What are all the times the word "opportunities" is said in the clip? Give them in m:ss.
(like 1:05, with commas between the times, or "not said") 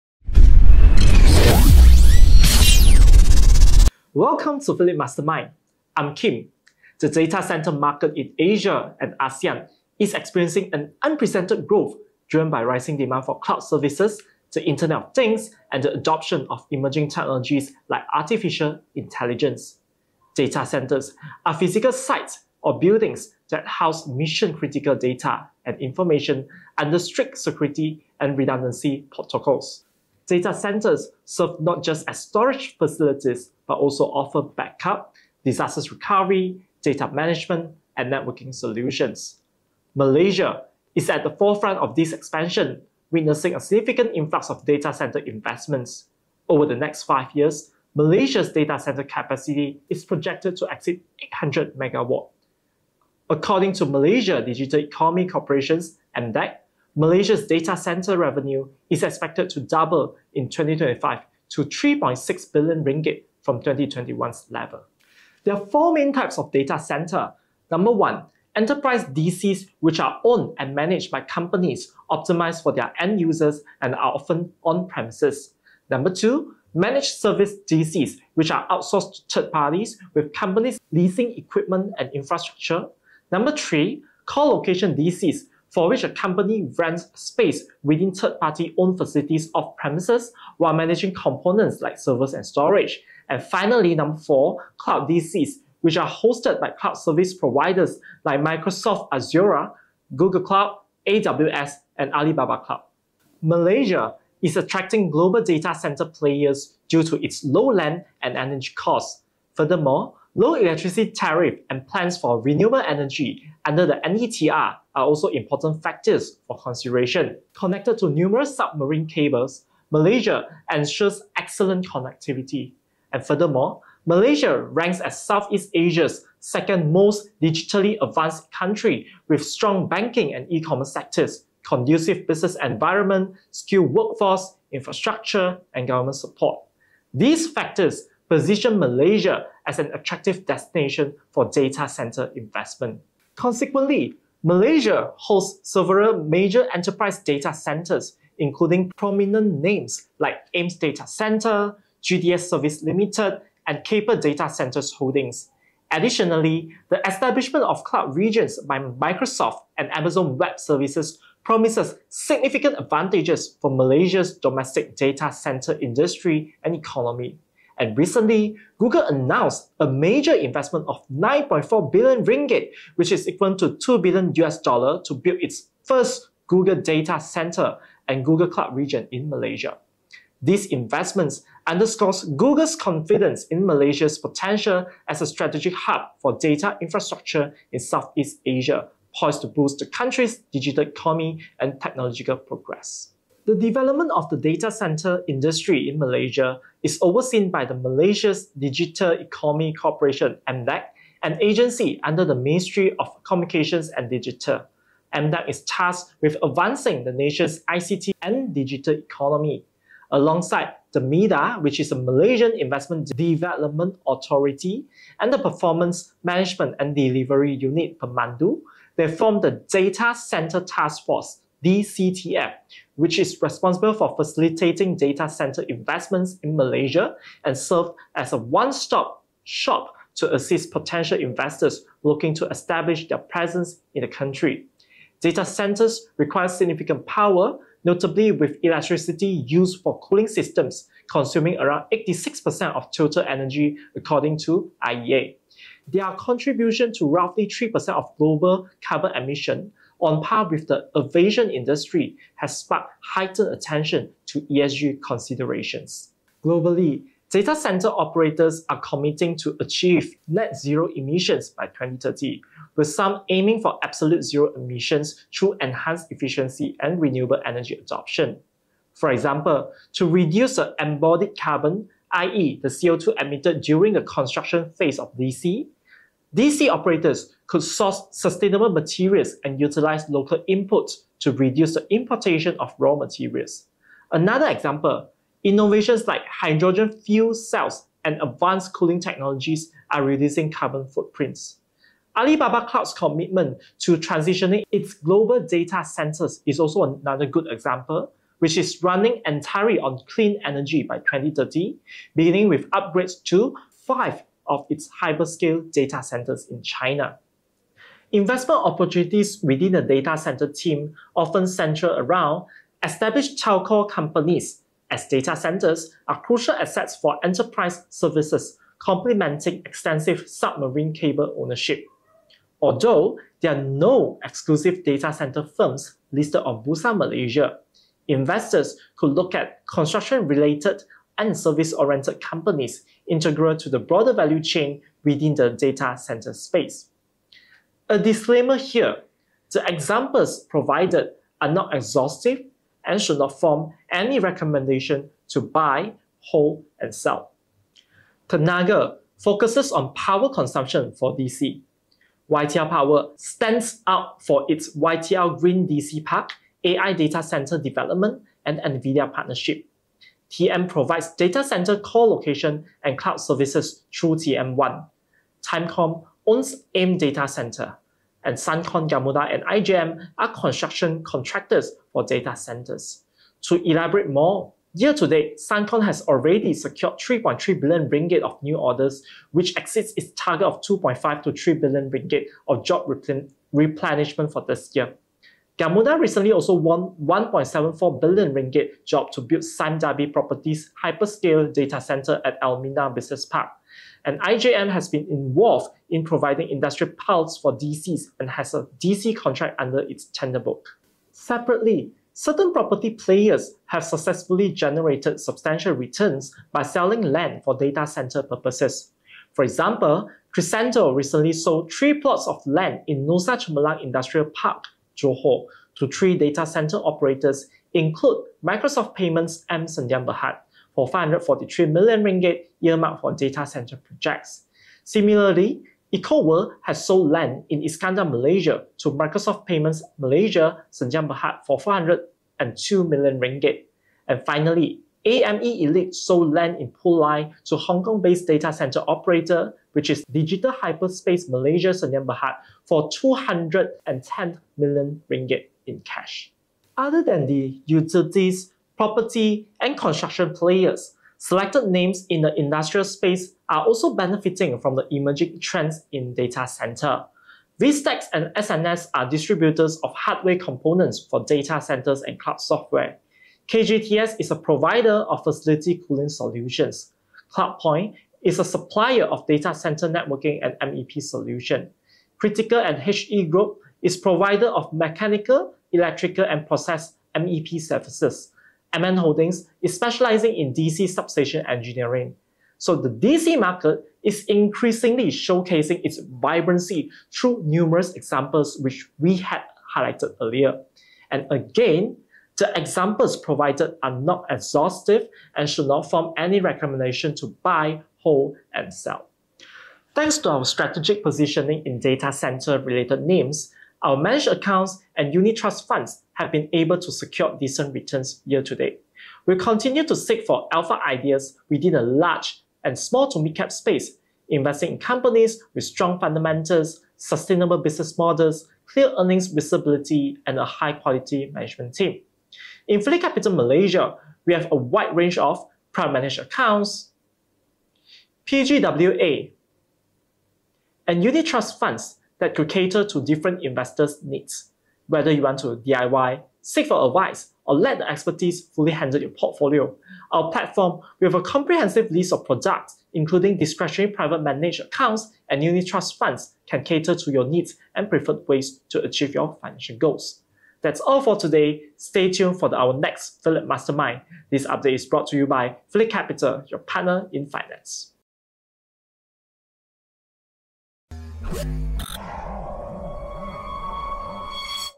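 5:08.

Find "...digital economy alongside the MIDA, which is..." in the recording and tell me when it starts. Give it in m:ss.
3:28.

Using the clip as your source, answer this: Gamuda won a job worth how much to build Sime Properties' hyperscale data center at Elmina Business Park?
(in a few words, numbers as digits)
1.74 billion ringgit.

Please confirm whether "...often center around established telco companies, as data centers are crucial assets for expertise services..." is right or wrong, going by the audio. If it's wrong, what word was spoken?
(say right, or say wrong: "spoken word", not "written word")
wrong: "enterprise", not "expertise".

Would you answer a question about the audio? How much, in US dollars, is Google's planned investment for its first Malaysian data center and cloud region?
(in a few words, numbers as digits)
2 billion US dollar.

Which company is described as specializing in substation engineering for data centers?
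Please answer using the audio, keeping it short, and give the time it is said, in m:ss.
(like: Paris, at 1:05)
MN Holdings, at 7:58.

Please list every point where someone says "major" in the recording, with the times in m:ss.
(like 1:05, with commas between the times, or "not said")
2:26, 2:49.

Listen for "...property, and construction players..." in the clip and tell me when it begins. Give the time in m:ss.
7:28.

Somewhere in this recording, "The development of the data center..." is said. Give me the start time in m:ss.
3:13.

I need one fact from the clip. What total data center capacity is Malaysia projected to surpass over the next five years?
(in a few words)
800 megawatt.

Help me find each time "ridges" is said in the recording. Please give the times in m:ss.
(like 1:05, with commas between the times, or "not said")
not said.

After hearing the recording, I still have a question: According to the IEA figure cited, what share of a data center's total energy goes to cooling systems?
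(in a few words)
86%.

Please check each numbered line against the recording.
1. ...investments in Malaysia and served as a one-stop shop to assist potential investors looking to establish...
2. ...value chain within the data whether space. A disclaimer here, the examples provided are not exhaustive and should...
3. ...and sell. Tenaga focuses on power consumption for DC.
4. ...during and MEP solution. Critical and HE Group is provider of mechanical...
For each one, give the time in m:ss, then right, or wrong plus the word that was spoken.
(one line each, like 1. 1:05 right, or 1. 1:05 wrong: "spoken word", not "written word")
1. 3:45 right
2. 5:34 wrong: "center", not "whether"
3. 5:46 right
4. 7:49 wrong: "networking", not "during".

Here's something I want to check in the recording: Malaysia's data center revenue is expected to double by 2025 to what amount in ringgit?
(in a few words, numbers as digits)
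3.6 billion ringgit.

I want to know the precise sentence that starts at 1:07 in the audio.
Number one, enterprise DCs, which are owned and managed by companies optimized for their end users and are often on premises.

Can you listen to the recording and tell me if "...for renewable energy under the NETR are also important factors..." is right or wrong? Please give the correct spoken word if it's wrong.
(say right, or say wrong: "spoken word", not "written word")
right.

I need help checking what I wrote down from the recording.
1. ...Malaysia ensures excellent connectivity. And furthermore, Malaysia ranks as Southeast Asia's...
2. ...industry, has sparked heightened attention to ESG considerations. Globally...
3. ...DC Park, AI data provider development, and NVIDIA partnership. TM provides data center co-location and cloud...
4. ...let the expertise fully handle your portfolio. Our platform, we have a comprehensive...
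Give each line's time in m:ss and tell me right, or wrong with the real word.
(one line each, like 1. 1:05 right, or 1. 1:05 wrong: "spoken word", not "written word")
1. 1:59 right
2. 4:11 right
3. 5:55 wrong: "center", not "provider"
4. 8:57 right.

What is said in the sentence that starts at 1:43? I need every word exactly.
Malaysia is attracting global data center players due to its low land and energy costs.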